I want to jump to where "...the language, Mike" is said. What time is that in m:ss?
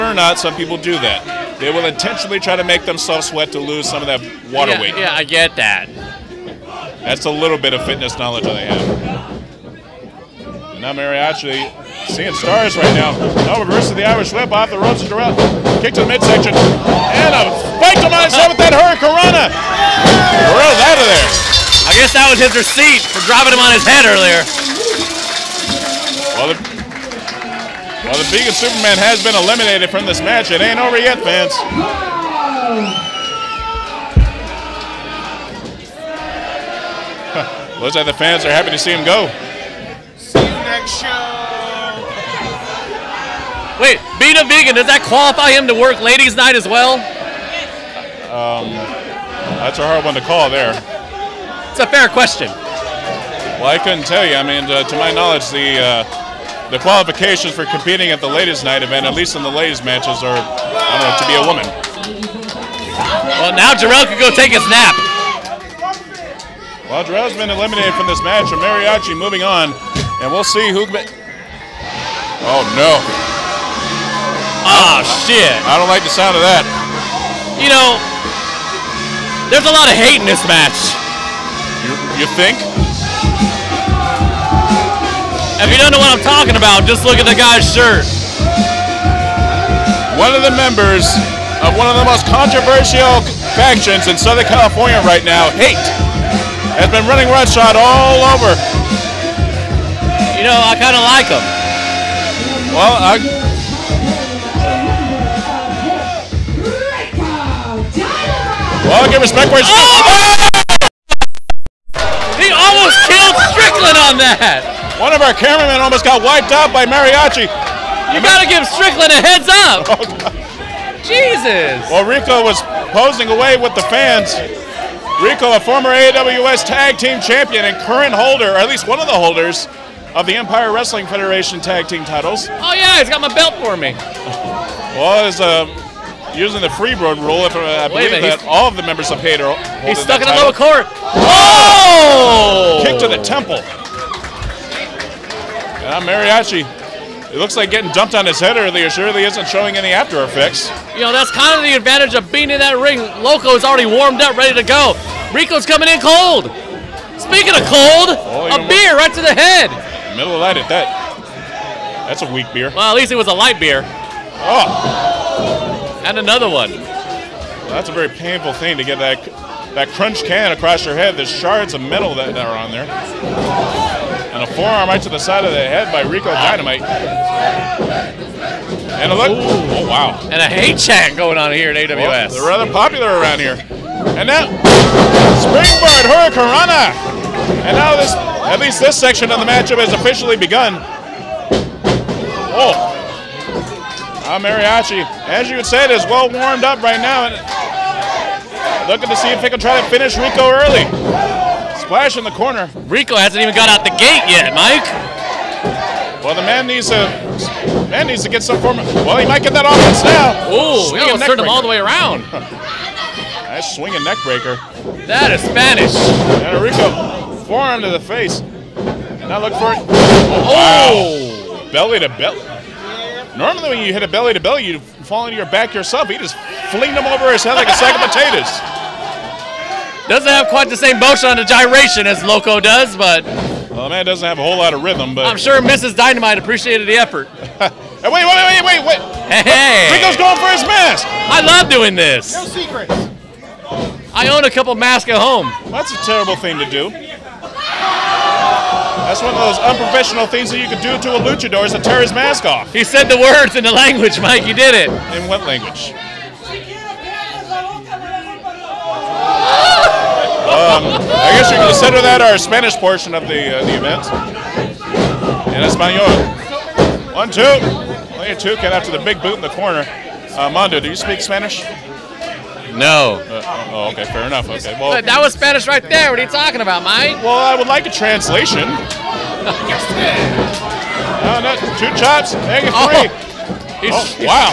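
4:13.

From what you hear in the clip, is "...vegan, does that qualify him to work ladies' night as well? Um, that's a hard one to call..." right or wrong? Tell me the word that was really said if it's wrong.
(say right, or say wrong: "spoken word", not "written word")
right.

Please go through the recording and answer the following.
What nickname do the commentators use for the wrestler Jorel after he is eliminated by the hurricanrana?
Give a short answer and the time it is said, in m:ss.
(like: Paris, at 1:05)
Vegan Superman, at 0:28.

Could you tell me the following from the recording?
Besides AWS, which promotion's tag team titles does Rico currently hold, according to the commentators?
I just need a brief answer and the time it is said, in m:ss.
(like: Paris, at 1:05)
Empire Wrestling Federation, at 2:10.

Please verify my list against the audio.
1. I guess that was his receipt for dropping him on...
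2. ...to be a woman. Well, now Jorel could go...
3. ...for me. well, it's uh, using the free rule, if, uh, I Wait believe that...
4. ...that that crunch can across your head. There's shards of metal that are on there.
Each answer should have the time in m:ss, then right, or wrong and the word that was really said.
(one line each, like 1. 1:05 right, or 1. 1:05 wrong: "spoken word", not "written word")
1. 0:21 right
2. 1:01 right
3. 2:13 right
4. 2:48 right.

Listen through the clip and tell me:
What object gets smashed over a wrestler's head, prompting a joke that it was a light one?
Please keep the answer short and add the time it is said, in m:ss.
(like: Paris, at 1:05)
A beer, at 2:38.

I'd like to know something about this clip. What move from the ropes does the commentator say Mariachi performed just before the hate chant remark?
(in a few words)
springboard hurricanrana.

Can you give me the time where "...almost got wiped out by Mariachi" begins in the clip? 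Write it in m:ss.
1:55.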